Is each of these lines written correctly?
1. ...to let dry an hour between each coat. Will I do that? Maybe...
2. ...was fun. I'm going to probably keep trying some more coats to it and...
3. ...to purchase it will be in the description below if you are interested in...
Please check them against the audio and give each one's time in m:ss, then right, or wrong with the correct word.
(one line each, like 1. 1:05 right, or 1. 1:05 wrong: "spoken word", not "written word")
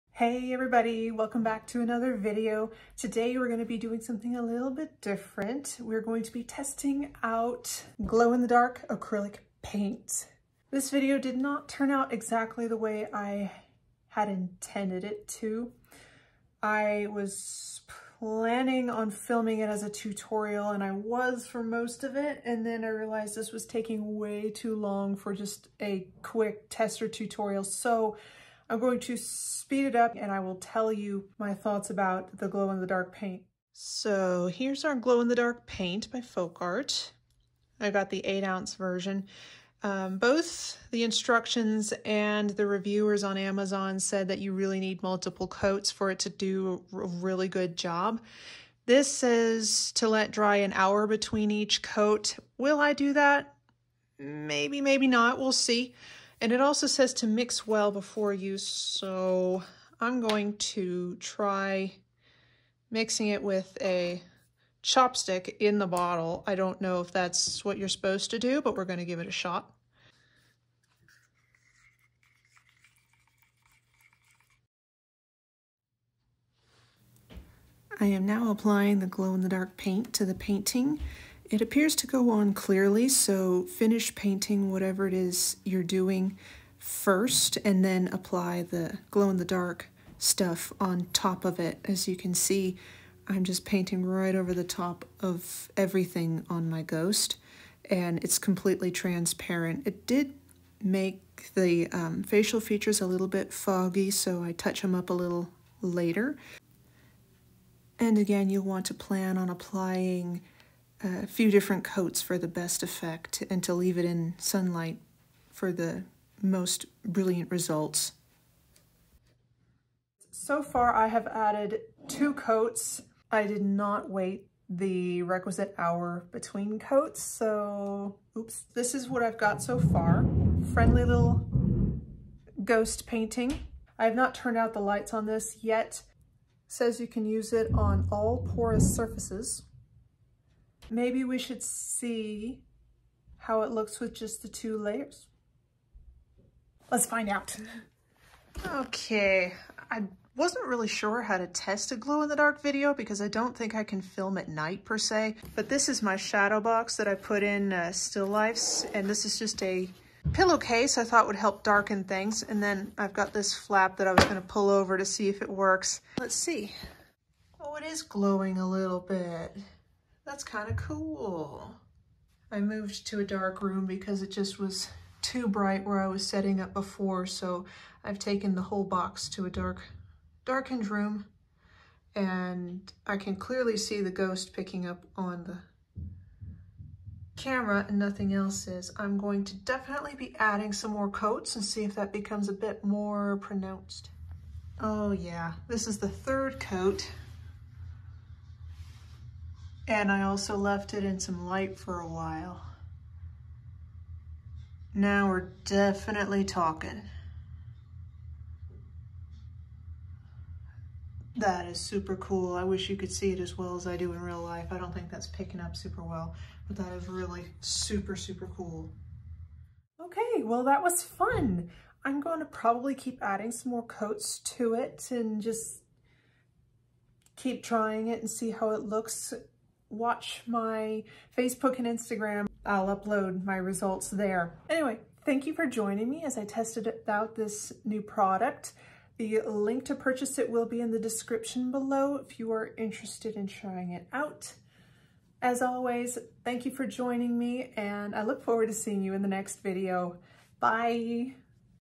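1. 0:49 right
2. 3:40 wrong: "adding", not "trying"
3. 3:59 right.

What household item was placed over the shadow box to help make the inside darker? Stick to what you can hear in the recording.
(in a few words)
pillowcase.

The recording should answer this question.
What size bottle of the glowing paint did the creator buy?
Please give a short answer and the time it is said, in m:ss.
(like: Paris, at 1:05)
8 ounce, at 0:38.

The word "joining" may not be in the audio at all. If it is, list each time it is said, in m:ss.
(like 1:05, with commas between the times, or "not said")
3:55, 4:06.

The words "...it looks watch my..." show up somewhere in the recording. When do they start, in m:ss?
3:48.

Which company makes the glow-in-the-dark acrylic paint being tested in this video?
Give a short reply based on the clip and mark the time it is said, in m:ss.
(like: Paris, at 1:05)
FolkArt, at 0:36.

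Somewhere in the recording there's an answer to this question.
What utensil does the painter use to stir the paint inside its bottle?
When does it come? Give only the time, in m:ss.
1:04.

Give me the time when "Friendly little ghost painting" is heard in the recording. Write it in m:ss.
2:10.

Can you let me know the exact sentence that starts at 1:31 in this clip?
As you can see, I'm just painting right over the top of everything on my ghost and it's completely transparent.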